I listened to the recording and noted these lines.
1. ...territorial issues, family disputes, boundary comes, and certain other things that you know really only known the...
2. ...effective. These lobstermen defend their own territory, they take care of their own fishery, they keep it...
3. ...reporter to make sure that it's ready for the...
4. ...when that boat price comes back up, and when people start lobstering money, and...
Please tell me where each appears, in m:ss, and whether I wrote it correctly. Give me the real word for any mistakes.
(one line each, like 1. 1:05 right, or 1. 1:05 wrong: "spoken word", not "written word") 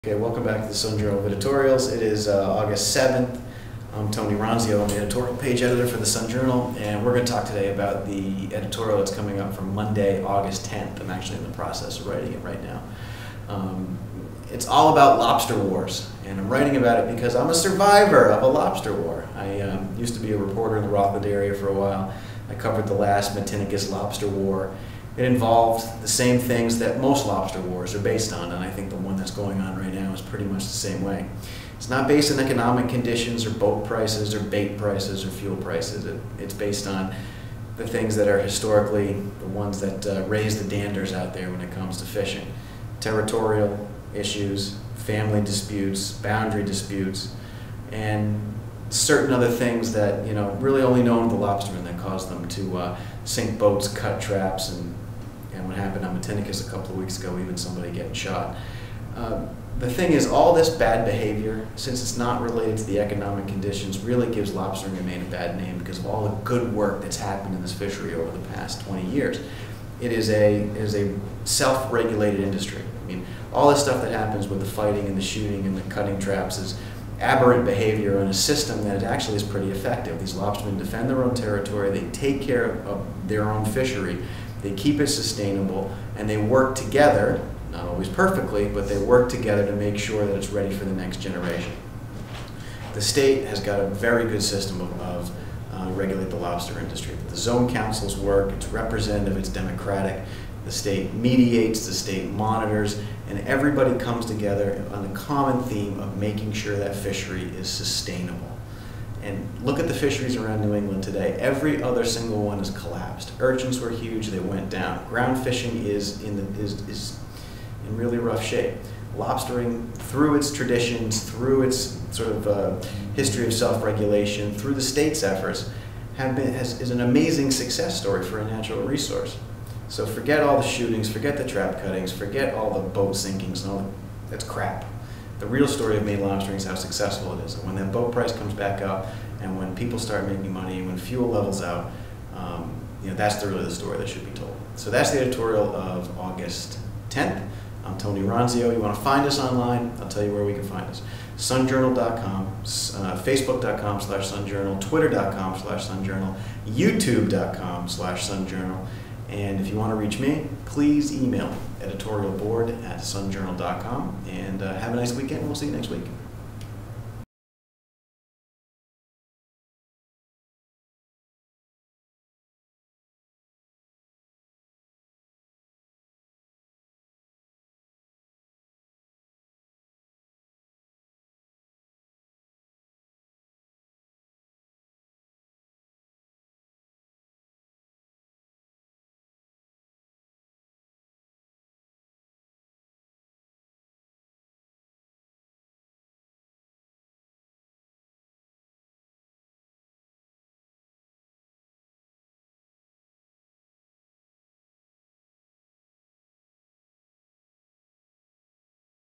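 1. 0:42 wrong: "disputes", not "comes"
2. 1:19 right
3. 1:29 wrong: "together", not "reporter"
4. 2:17 wrong: "making", not "lobstering".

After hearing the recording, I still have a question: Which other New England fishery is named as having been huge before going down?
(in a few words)
Urchins.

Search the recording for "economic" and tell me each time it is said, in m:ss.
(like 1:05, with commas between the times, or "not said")
0:32, 1:02.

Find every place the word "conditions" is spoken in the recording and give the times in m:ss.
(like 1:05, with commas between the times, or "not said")
0:32, 1:03.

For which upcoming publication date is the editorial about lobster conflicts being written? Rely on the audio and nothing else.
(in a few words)
Monday, August 10th.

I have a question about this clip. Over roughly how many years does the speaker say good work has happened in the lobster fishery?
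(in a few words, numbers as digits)
20 years.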